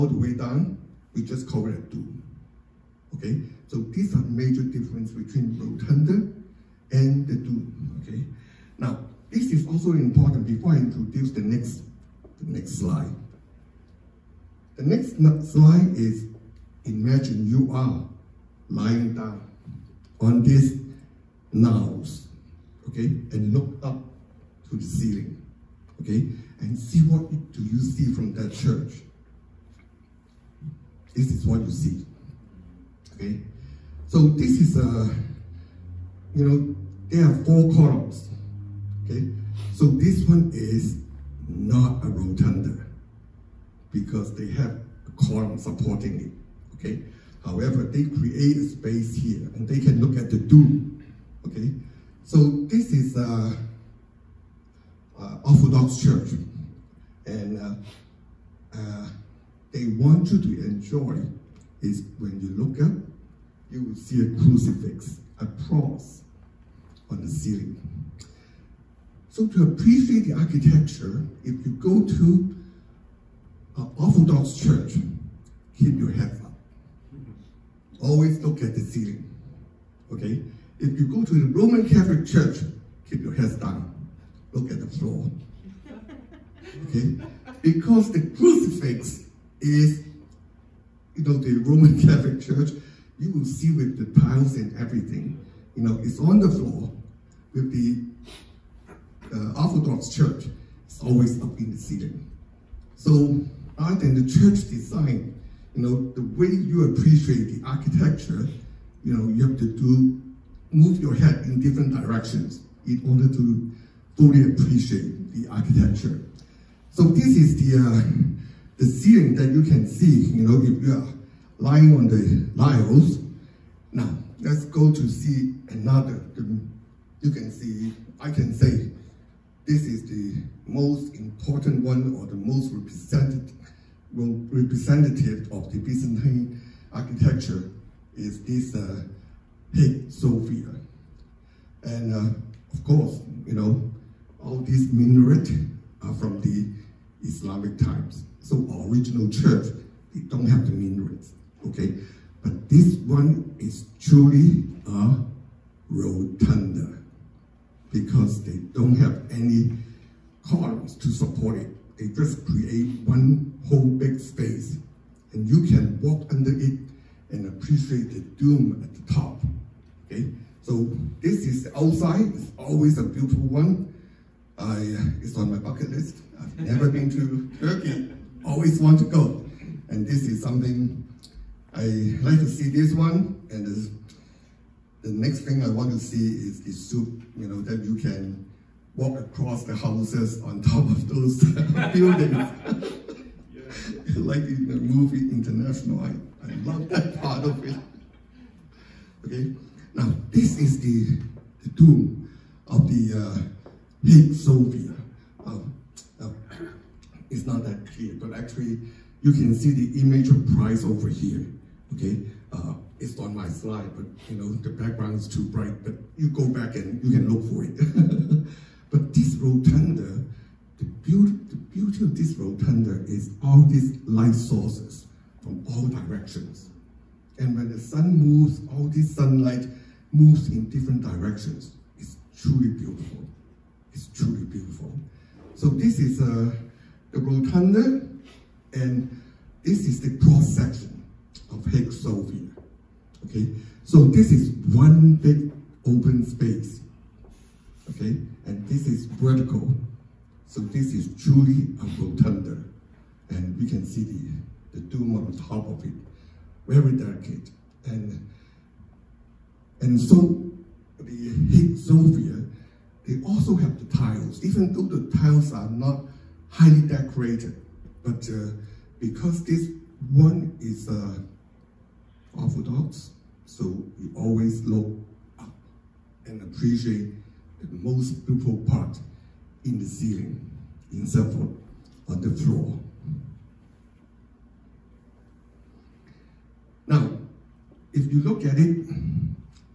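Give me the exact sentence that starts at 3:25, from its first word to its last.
Uh, uh, it's not that clear, but actually you can see the image of Christ over here.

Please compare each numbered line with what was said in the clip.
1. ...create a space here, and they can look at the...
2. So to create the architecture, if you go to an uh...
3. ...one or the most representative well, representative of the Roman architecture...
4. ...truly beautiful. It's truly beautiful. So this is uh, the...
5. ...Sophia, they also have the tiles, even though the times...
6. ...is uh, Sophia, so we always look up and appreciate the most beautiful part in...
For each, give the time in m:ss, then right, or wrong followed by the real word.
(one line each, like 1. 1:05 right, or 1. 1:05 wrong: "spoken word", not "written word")
1. 0:48 right
2. 1:09 wrong: "appreciate", not "create"
3. 2:11 wrong: "Byzantine", not "Roman"
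4. 3:52 right
5. 4:21 wrong: "tiles", not "times"
6. 4:30 wrong: "Orthodox", not "Sophia".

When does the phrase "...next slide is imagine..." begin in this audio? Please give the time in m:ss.
0:14.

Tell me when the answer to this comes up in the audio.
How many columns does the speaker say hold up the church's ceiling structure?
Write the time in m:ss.
0:37.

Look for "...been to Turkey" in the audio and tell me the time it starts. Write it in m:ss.
2:56.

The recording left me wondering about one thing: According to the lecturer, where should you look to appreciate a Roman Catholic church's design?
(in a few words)
At the floor.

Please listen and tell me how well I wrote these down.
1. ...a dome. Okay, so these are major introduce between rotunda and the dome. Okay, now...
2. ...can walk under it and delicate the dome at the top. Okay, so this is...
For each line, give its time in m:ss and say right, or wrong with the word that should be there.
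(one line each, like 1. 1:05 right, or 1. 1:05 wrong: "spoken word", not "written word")
1. 0:01 wrong: "difference", not "introduce"
2. 2:45 wrong: "appreciate", not "delicate".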